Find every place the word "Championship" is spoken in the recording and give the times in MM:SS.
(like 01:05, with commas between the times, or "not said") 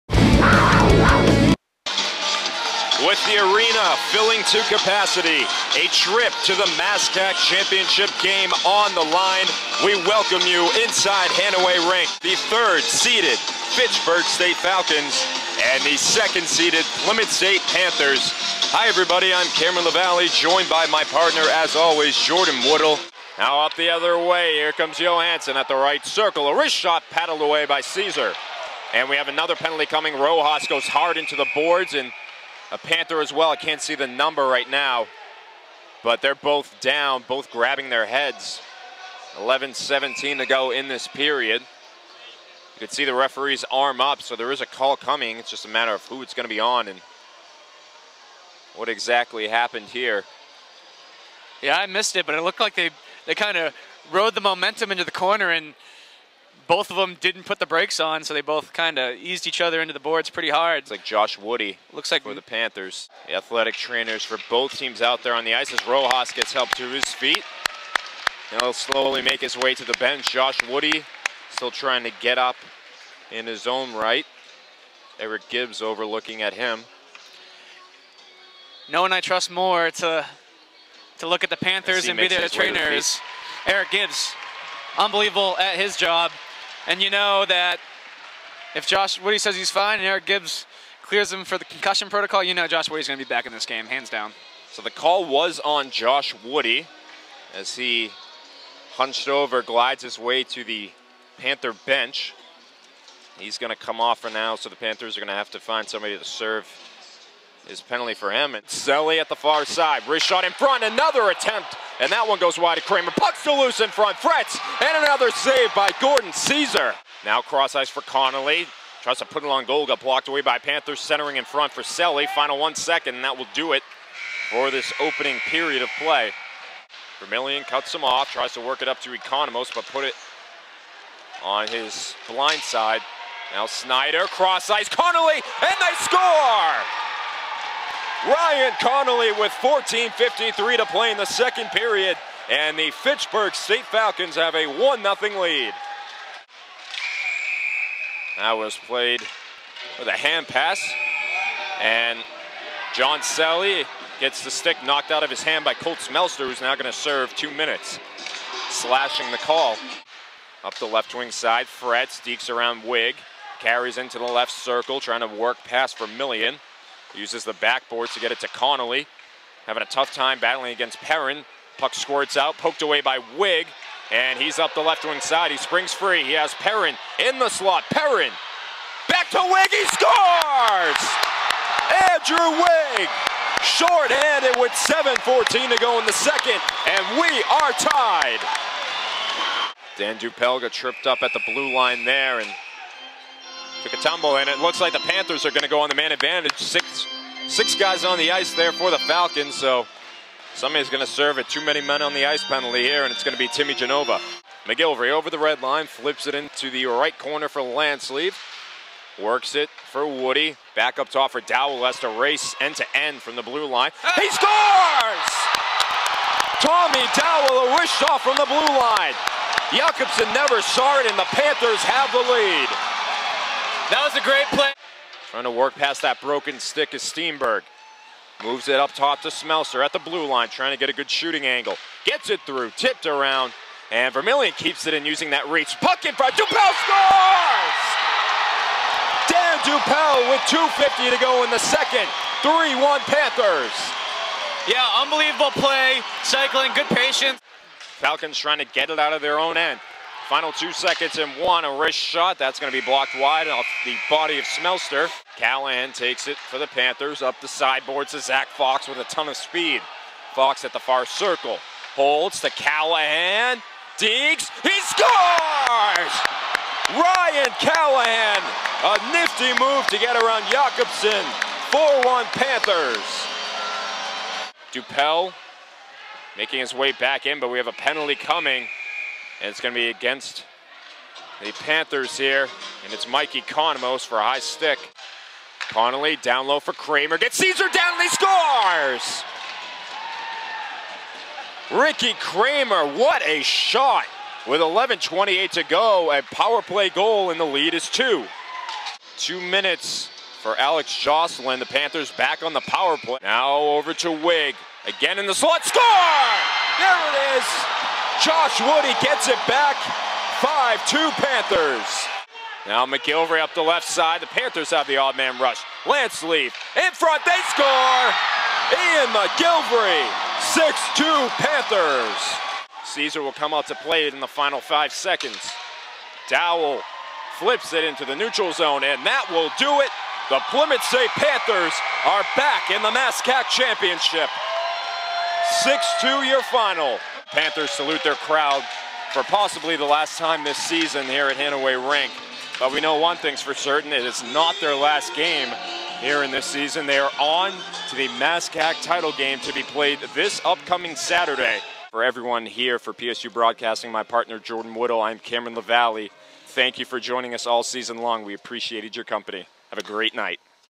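00:07, 05:33.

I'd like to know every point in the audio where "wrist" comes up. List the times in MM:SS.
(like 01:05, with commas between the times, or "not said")
00:26, 01:50, 04:11.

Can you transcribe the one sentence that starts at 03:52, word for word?
Gets it through, tipped around, and Vermillion keeps it in using that reach.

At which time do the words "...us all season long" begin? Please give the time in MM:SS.
05:57.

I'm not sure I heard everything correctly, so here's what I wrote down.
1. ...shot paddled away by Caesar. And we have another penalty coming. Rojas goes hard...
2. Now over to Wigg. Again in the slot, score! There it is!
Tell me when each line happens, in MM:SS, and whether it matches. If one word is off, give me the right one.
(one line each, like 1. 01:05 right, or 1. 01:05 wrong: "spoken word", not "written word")
1. 00:26 right
2. 05:03 right.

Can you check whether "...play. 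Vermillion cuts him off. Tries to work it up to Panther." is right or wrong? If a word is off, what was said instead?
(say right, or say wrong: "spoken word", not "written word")
wrong: "Economos", not "Panther".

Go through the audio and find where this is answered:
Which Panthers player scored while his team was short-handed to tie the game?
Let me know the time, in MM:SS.
03:02.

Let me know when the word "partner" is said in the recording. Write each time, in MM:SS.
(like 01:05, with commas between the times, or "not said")
00:21, 05:54.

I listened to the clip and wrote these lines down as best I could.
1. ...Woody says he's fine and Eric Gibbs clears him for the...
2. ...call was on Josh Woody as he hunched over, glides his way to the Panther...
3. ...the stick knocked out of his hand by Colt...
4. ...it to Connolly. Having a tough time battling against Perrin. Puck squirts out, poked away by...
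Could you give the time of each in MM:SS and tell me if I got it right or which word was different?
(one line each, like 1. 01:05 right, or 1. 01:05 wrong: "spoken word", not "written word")
1. 01:29 right
2. 01:34 right
3. 02:34 right
4. 02:48 right.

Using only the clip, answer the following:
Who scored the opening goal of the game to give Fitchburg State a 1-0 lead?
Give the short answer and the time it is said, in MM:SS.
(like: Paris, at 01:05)
Ryan Connolly, at 02:18.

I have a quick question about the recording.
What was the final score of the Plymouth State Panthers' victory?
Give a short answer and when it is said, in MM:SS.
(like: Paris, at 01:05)
6-2, at 05:35.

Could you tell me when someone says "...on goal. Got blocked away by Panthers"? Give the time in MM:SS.
01:59.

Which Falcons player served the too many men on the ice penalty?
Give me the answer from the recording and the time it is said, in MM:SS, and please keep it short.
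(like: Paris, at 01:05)
Timmy Genova, at 03:23.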